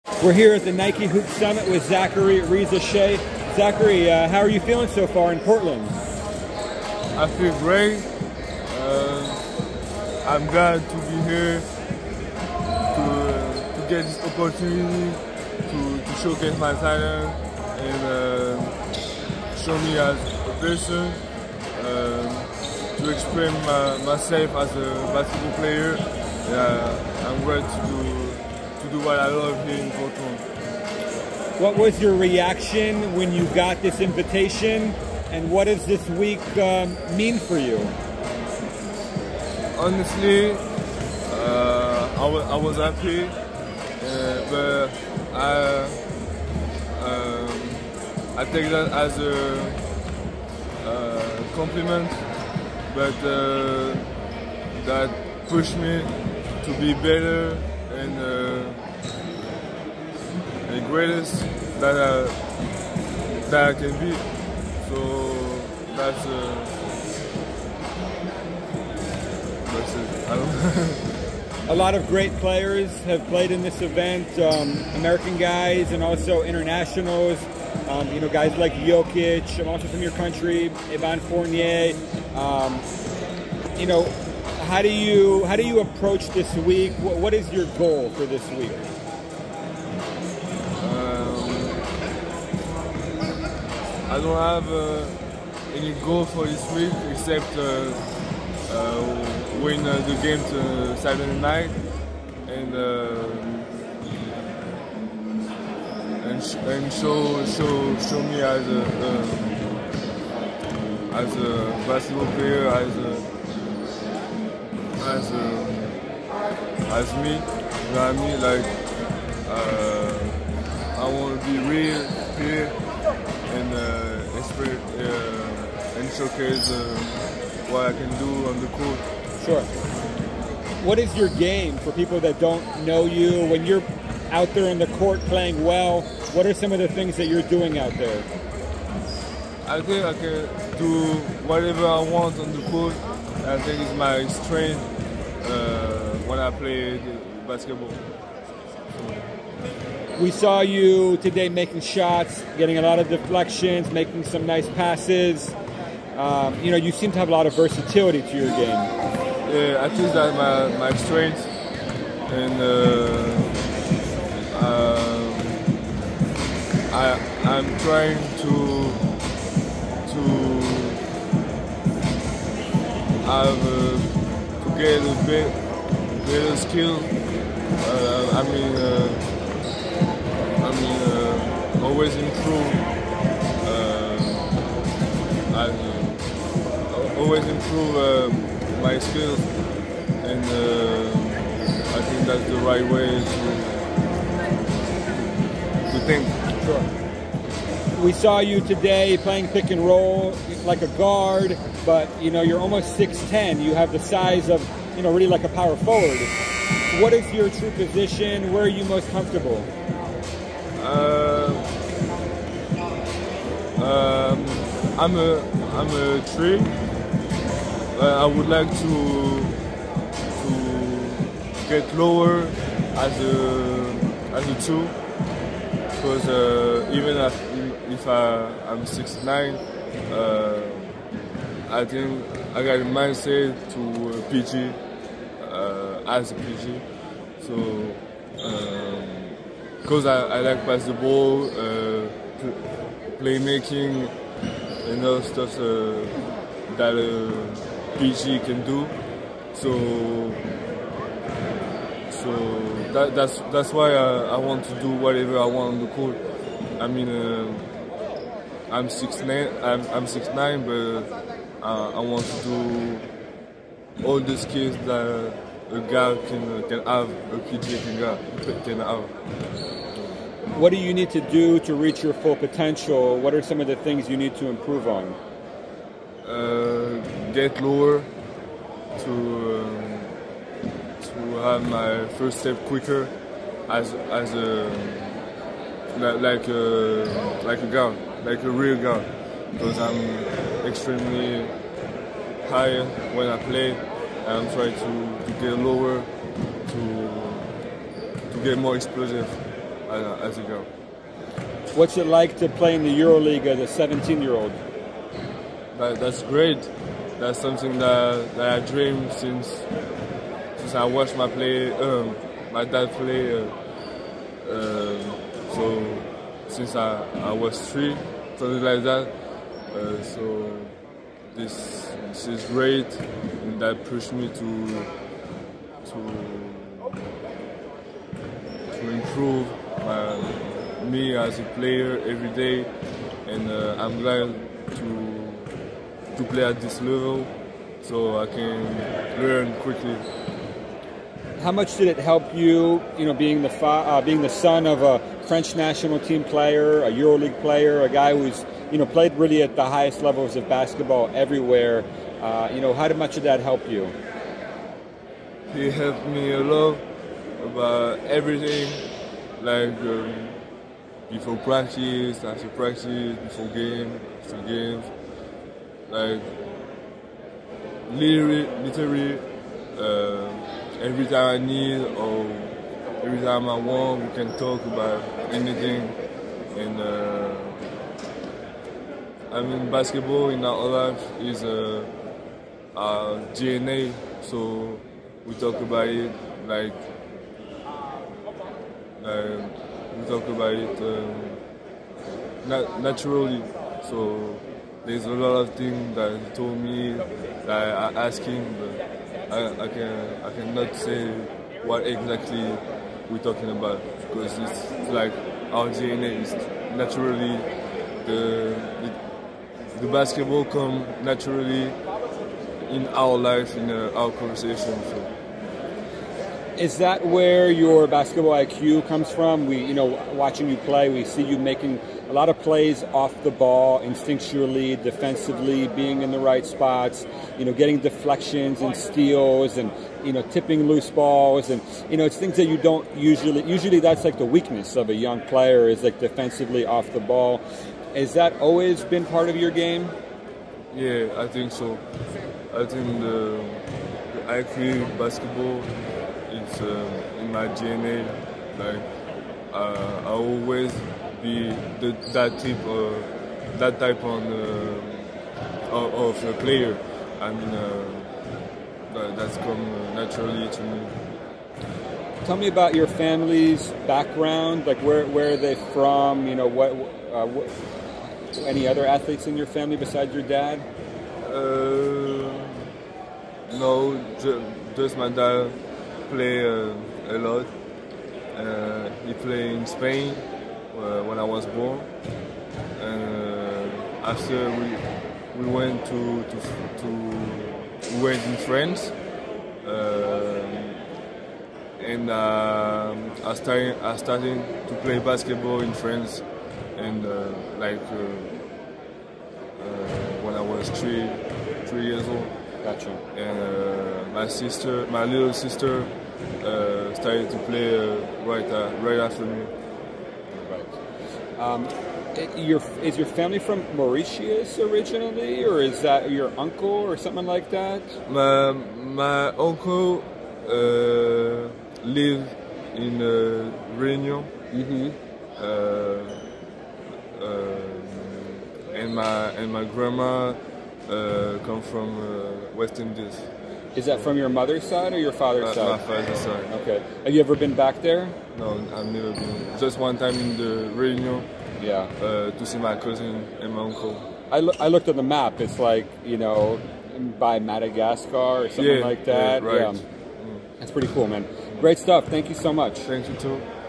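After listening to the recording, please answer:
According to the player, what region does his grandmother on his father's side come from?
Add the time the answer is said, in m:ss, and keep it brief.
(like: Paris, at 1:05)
West Indies, at 8:52.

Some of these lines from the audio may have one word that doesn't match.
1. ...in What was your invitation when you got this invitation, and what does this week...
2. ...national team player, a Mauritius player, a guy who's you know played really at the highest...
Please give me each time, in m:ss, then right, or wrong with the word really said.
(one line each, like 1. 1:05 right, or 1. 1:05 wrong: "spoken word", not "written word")
1. 0:29 wrong: "reaction", not "invitation"
2. 5:45 wrong: "EuroLeague", not "Mauritius".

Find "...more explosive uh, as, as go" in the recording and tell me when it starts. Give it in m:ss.
4:58.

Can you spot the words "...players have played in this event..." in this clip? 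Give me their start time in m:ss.
1:12.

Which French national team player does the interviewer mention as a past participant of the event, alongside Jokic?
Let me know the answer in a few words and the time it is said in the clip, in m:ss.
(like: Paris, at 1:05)
Evan Fournier, at 1:20.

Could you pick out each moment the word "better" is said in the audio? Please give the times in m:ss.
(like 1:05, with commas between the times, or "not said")
0:56, 2:56.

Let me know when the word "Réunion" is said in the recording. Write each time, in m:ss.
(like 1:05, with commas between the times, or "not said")
8:43, 9:00.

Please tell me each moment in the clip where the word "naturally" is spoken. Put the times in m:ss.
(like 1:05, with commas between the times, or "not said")
6:32, 6:46, 6:51, 7:39.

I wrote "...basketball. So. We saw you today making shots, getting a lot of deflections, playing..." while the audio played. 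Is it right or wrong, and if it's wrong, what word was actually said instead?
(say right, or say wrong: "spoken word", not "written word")
wrong: "making", not "playing".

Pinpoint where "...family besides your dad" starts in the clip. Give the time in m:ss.
7:49.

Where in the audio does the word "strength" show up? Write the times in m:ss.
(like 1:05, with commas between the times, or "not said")
2:24, 2:40.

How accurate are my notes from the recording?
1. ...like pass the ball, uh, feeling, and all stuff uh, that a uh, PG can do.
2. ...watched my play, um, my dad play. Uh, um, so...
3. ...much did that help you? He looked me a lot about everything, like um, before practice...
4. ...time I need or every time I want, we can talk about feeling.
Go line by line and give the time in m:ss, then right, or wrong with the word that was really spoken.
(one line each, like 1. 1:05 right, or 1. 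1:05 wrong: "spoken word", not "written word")
1. 4:00 wrong: "playmaking", not "feeling"
2. 5:10 right
3. 5:52 wrong: "helped", not "looked"
4. 6:11 wrong: "anything", not "feeling".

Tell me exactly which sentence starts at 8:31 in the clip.
Um, your, is your family from Mauritius originally, or is that your uncle or something like that?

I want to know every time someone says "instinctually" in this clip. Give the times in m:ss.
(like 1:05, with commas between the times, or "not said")
7:03.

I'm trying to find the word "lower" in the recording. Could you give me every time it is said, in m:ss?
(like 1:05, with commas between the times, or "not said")
3:41, 4:37, 4:55.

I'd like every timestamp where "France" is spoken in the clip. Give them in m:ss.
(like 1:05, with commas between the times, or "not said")
8:08, 8:15.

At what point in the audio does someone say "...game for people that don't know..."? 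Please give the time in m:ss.
2:11.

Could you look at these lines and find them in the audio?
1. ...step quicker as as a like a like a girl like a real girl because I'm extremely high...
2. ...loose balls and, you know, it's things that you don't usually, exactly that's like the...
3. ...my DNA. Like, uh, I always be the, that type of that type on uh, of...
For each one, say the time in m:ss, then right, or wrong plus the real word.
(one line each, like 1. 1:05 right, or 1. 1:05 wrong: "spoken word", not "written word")
1. 4:42 right
2. 7:10 wrong: "usually", not "exactly"
3. 7:27 right.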